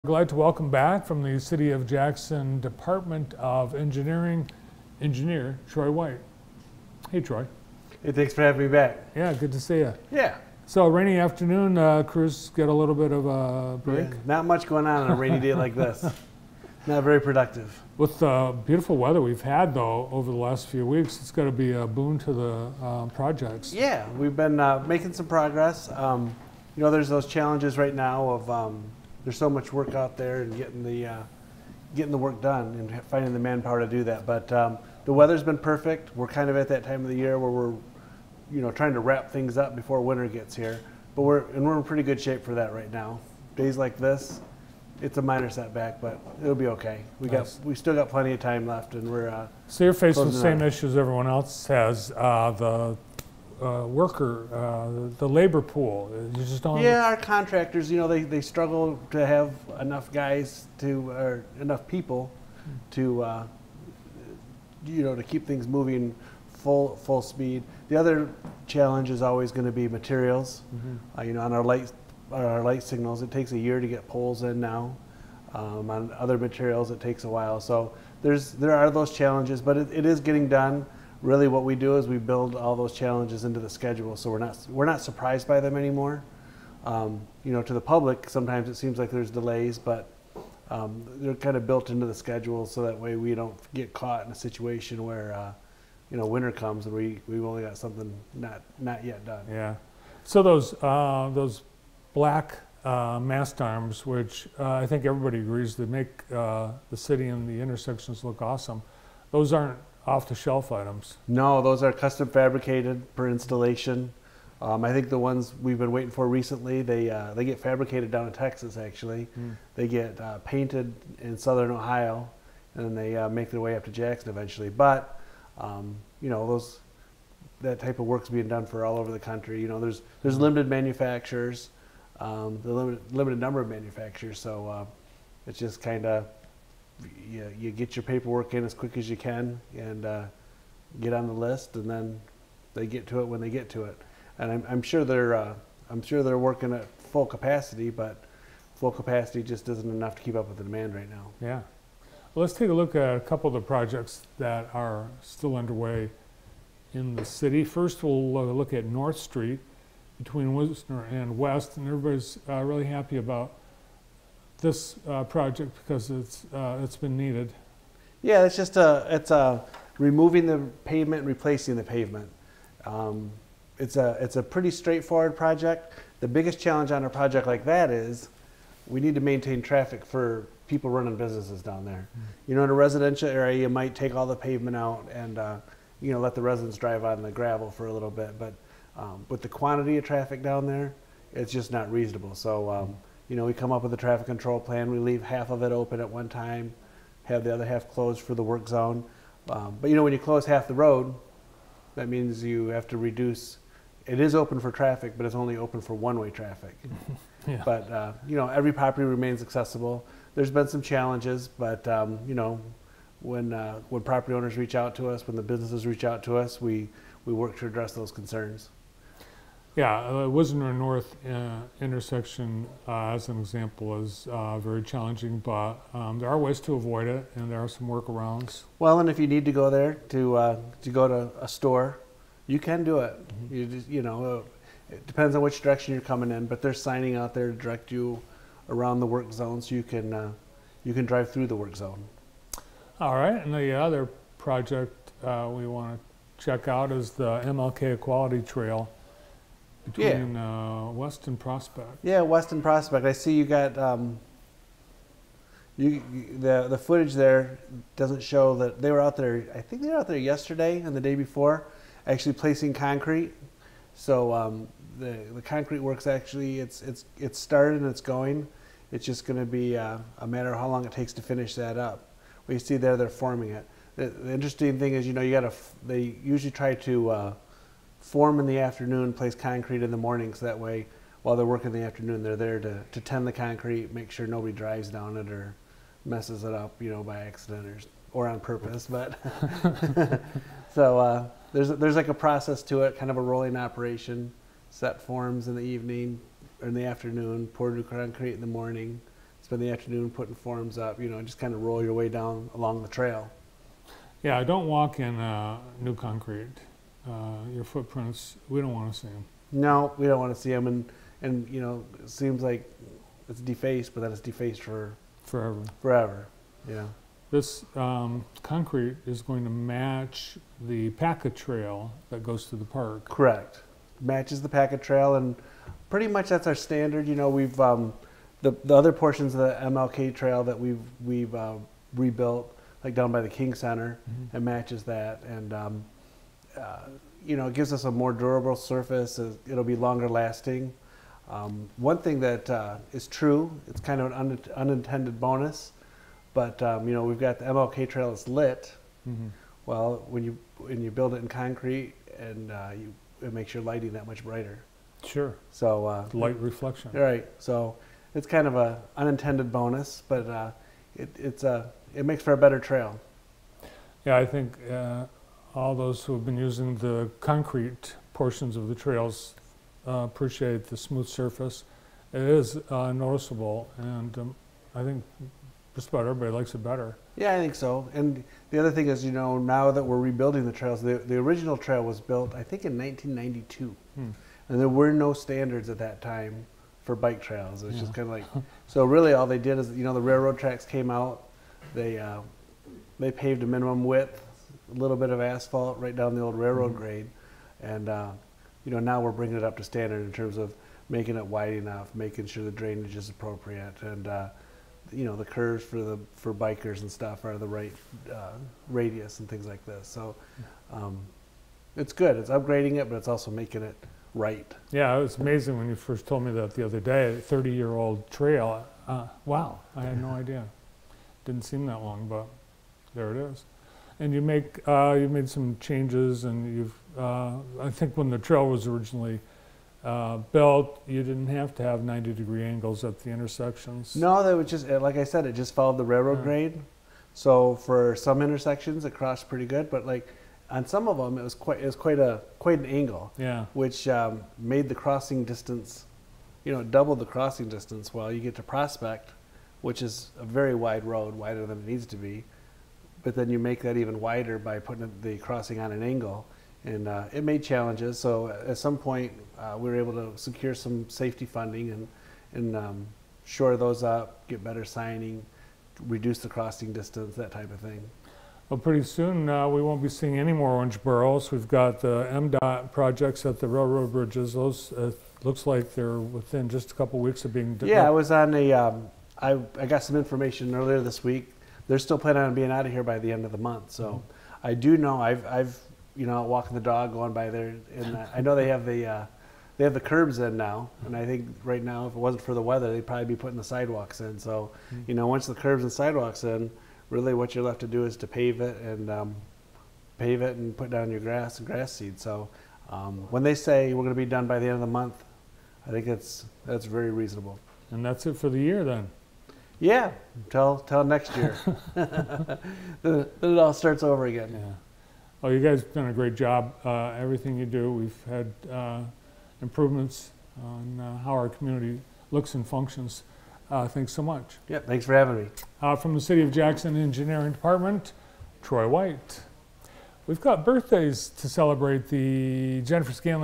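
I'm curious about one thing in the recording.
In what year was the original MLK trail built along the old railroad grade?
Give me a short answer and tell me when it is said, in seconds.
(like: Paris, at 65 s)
1992, at 382 s.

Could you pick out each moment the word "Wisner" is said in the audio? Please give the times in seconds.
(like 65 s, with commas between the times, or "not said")
160 s, 220 s.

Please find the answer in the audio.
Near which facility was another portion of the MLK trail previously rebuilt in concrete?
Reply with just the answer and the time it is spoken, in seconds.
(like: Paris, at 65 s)
the King Center, at 333 s.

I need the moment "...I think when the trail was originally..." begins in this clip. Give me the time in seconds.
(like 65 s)
427 s.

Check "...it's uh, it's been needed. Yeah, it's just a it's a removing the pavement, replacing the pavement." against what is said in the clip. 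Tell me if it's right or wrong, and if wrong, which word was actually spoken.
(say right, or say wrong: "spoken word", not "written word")
right.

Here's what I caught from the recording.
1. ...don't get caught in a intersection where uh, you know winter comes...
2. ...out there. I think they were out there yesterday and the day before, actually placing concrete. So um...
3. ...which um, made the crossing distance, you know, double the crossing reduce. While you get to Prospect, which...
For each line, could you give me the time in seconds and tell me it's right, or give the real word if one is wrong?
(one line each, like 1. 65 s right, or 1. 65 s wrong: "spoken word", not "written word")
1. 93 s wrong: "situation", not "intersection"
2. 259 s right
3. 443 s wrong: "distance", not "reduce".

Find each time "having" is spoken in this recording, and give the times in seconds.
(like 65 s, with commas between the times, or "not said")
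8 s, 524 s.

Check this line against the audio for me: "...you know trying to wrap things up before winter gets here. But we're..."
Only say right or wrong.
right.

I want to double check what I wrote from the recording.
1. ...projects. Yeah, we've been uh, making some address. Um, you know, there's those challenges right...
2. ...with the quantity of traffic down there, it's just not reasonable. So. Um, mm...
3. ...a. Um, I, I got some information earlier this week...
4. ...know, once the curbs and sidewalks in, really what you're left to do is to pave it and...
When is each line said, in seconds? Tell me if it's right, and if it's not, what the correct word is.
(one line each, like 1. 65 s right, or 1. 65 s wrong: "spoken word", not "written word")
1. 23 s wrong: "progress", not "address"
2. 189 s right
3. 478 s right
4. 494 s right.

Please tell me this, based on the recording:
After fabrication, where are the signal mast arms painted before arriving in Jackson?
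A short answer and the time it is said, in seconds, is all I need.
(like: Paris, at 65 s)
Southern Ohio, at 121 s.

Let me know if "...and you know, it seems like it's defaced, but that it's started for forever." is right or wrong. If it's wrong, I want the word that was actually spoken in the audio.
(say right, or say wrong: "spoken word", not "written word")
wrong: "defaced", not "started".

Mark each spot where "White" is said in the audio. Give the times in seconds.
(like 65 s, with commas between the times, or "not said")
5 s, 528 s.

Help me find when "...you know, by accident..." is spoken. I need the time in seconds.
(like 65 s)
286 s.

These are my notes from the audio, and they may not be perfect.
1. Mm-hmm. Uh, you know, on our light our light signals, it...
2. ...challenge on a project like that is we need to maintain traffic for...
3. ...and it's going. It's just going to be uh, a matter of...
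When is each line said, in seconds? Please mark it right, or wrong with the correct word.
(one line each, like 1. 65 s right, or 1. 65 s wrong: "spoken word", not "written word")
1. 70 s right
2. 176 s right
3. 267 s right.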